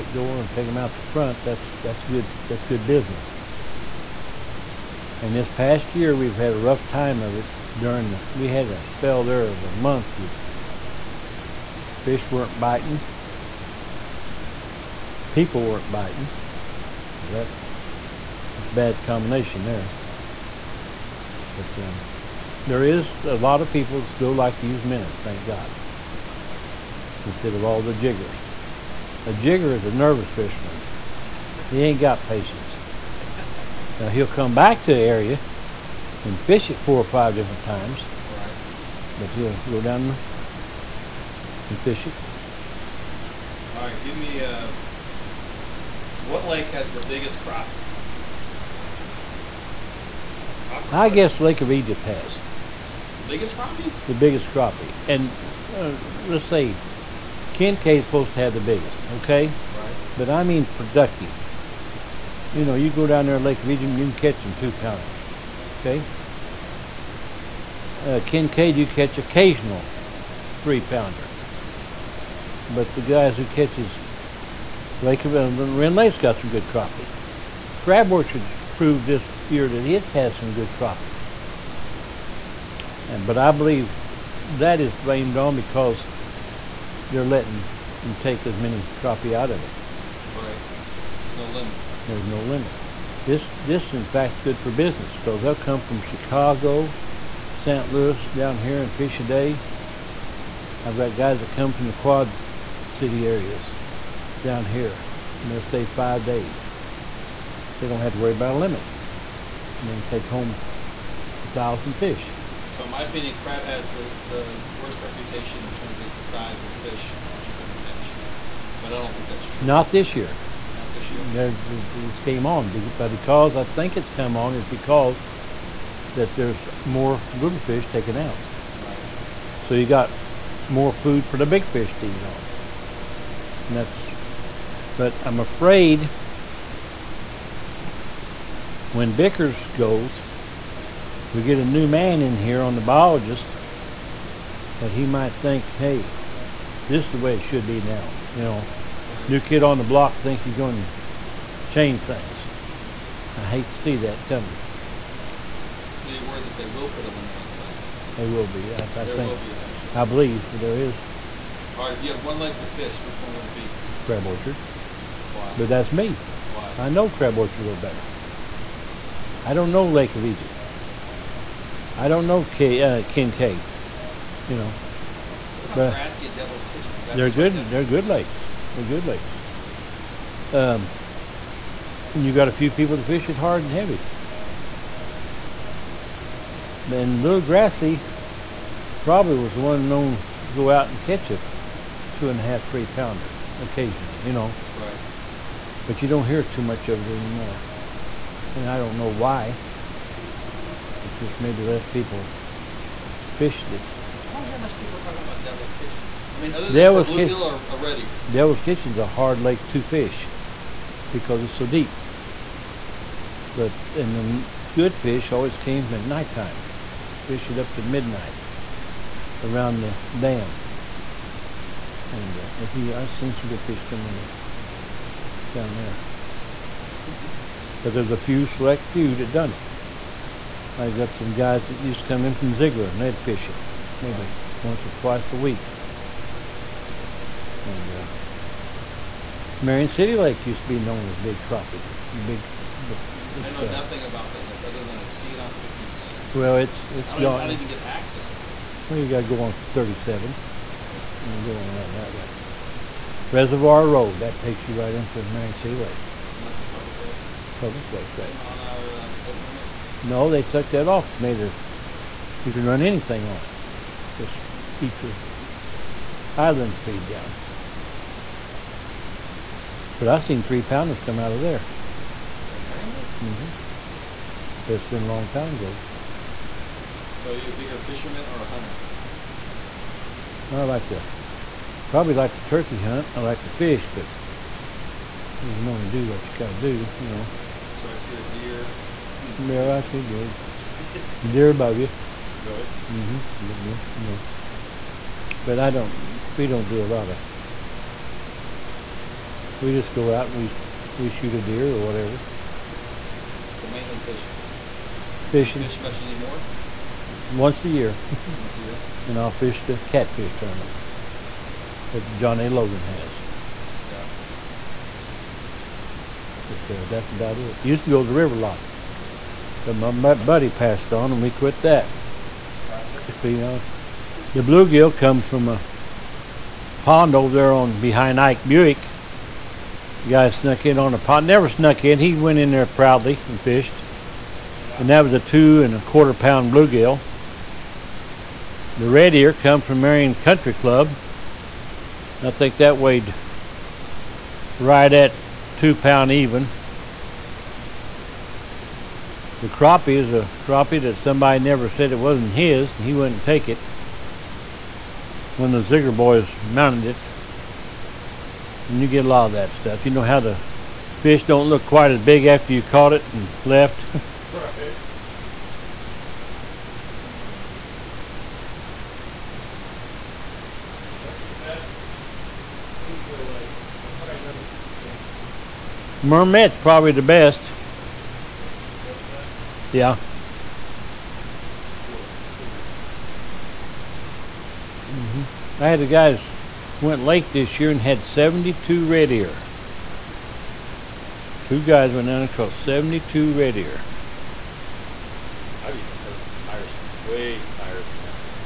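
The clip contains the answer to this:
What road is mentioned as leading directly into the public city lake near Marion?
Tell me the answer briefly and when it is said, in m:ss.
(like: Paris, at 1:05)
Reservoir Road, at 4:13.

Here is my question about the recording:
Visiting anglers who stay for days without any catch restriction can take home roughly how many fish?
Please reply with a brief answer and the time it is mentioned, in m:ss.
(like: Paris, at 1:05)
1,000, at 1:51.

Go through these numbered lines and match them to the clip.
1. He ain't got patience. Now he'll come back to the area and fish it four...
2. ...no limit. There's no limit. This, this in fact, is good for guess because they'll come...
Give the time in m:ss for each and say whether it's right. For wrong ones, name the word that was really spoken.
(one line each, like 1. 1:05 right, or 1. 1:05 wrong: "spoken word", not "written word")
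1. 0:31 right
2. 1:31 wrong: "business", not "guess".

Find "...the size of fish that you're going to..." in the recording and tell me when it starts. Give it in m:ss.
1:56.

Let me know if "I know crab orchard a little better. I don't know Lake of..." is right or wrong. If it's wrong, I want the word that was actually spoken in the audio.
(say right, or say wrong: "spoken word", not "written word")
right.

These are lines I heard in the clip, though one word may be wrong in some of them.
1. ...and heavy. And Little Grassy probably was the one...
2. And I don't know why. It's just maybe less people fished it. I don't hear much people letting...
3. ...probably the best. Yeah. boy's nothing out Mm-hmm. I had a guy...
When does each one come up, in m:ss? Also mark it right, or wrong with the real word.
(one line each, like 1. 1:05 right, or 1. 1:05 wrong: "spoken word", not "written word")
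1. 3:03 right
2. 3:18 wrong: "talking", not "letting"
3. 6:16 wrong: "killing", not "nothing".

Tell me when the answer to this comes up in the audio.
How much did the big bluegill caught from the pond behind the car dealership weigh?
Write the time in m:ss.
5:35.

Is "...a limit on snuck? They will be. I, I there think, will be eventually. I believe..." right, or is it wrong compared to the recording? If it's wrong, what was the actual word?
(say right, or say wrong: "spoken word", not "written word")
wrong: "crack", not "snuck".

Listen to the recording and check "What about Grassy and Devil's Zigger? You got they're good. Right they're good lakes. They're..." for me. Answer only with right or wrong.
wrong.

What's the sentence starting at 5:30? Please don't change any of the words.
The guy snuck in on a pond, never snuck in.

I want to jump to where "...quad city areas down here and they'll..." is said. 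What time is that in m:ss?
1:41.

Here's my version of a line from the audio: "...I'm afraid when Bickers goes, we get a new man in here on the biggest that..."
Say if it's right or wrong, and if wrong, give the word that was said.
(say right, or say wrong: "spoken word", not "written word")
wrong: "biologist", not "biggest".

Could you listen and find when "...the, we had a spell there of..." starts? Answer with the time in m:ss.
0:08.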